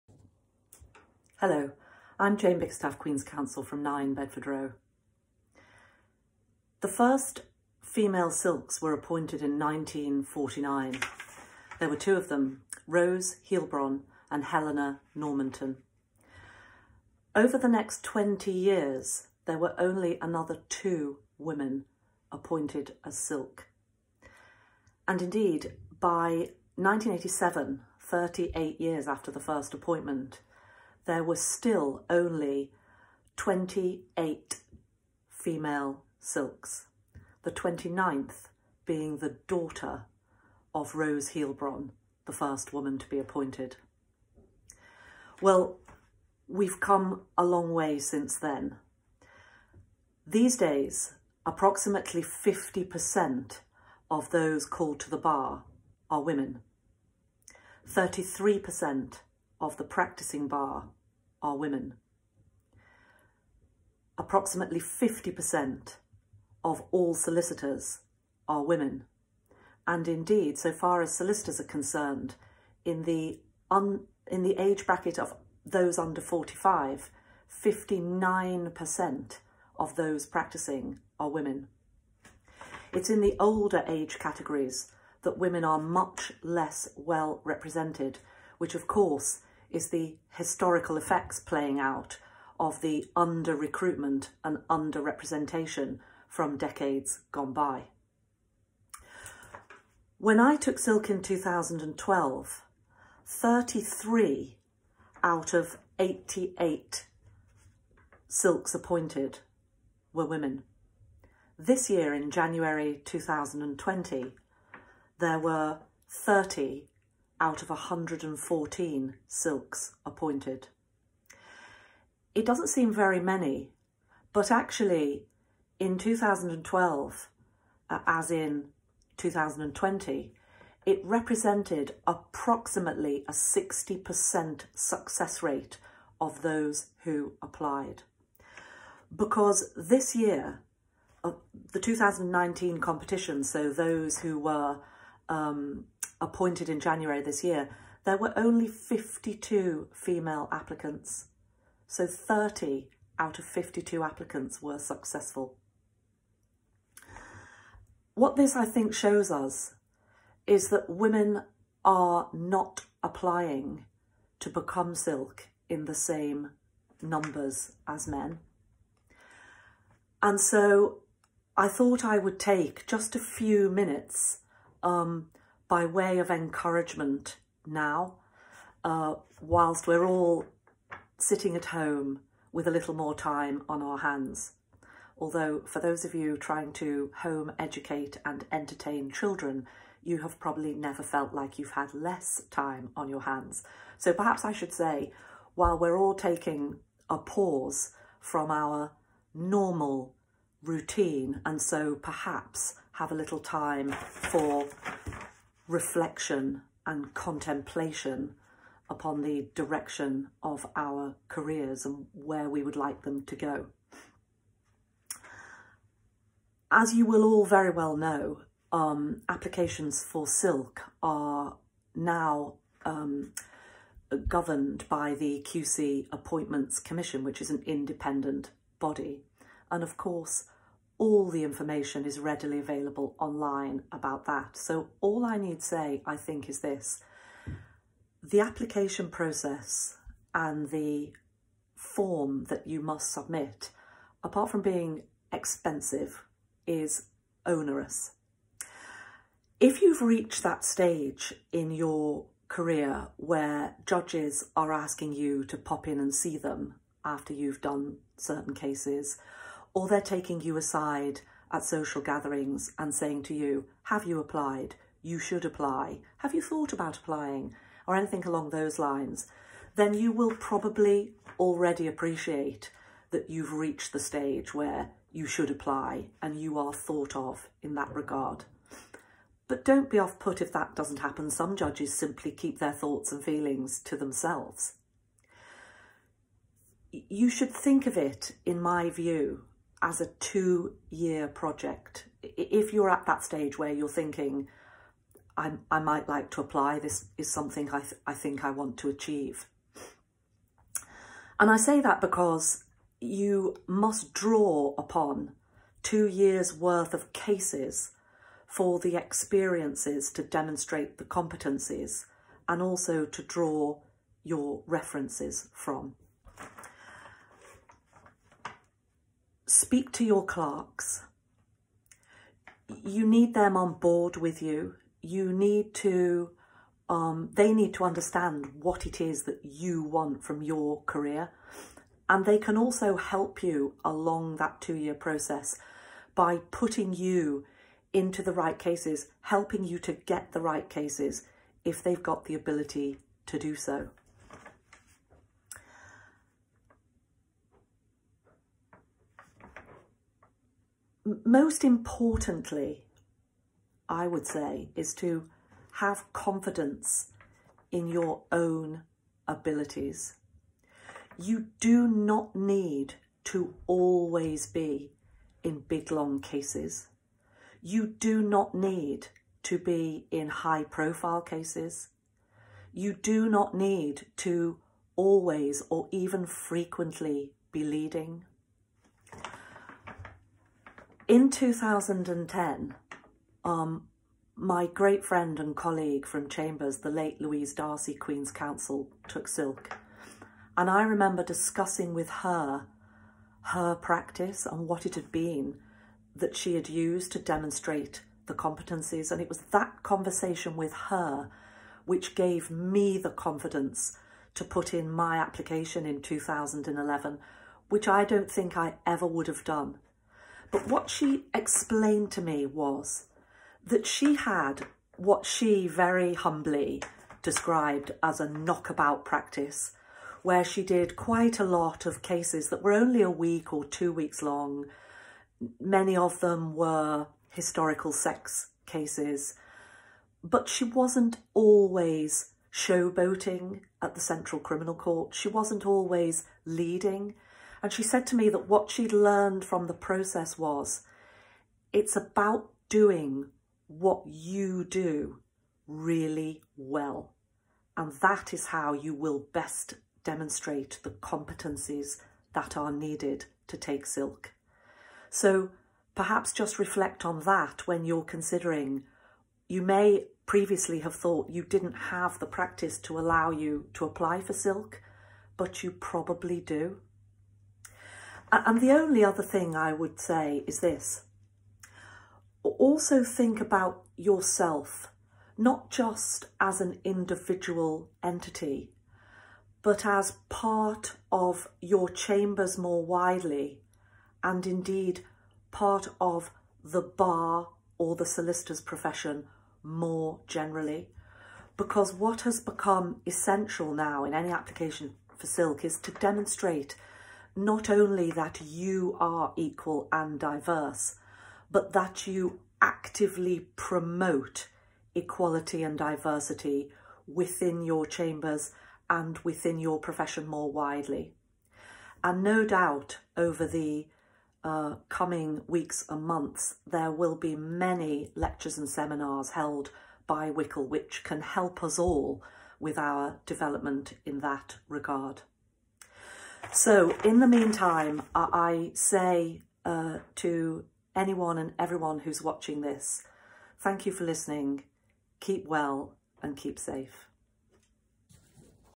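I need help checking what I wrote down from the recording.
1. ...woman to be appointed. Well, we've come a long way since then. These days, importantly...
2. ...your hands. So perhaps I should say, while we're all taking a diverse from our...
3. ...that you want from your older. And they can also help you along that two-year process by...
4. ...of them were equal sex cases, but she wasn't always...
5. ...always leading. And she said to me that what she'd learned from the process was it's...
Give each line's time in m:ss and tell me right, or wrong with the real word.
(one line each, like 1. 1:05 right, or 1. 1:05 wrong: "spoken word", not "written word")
1. 0:42 wrong: "approximately", not "importantly"
2. 3:13 wrong: "pause", not "diverse"
3. 5:29 wrong: "career", not "older"
4. 7:05 wrong: "historical", not "equal"
5. 7:15 right.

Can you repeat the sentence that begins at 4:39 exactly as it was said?
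But don't be off put if that doesn't happen.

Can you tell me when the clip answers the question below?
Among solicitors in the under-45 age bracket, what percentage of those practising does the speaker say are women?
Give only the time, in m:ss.
1:17.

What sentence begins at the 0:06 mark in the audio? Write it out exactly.
The first female silks were appointed in 1949.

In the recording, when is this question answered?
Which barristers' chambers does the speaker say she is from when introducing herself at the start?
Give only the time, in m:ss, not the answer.
0:03.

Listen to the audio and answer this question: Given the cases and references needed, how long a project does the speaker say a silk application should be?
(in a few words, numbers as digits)
two years.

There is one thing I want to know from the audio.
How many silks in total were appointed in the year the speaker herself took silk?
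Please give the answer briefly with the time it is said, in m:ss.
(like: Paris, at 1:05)
88, at 1:45.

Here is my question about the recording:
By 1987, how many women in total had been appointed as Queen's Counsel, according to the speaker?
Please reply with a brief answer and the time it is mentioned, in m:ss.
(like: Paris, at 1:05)
28, at 0:33.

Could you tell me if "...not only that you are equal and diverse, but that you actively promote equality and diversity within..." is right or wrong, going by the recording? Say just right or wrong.
right.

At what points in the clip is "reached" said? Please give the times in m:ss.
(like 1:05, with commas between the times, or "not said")
4:10, 4:33.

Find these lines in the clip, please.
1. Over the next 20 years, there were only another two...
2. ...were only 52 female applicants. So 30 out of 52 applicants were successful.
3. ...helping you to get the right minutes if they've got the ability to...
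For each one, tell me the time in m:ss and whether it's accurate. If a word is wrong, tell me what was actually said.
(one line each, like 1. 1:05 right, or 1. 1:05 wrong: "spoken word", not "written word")
1. 0:17 right
2. 2:28 right
3. 5:39 wrong: "cases", not "minutes".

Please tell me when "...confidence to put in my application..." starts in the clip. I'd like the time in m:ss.
6:43.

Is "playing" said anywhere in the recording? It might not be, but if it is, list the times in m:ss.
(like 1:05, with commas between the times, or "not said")
1:31.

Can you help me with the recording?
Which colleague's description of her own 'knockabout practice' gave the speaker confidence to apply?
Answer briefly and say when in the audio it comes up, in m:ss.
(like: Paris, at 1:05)
Louise Darcy, at 6:27.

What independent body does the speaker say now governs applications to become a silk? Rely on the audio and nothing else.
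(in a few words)
QC Appointments Commission.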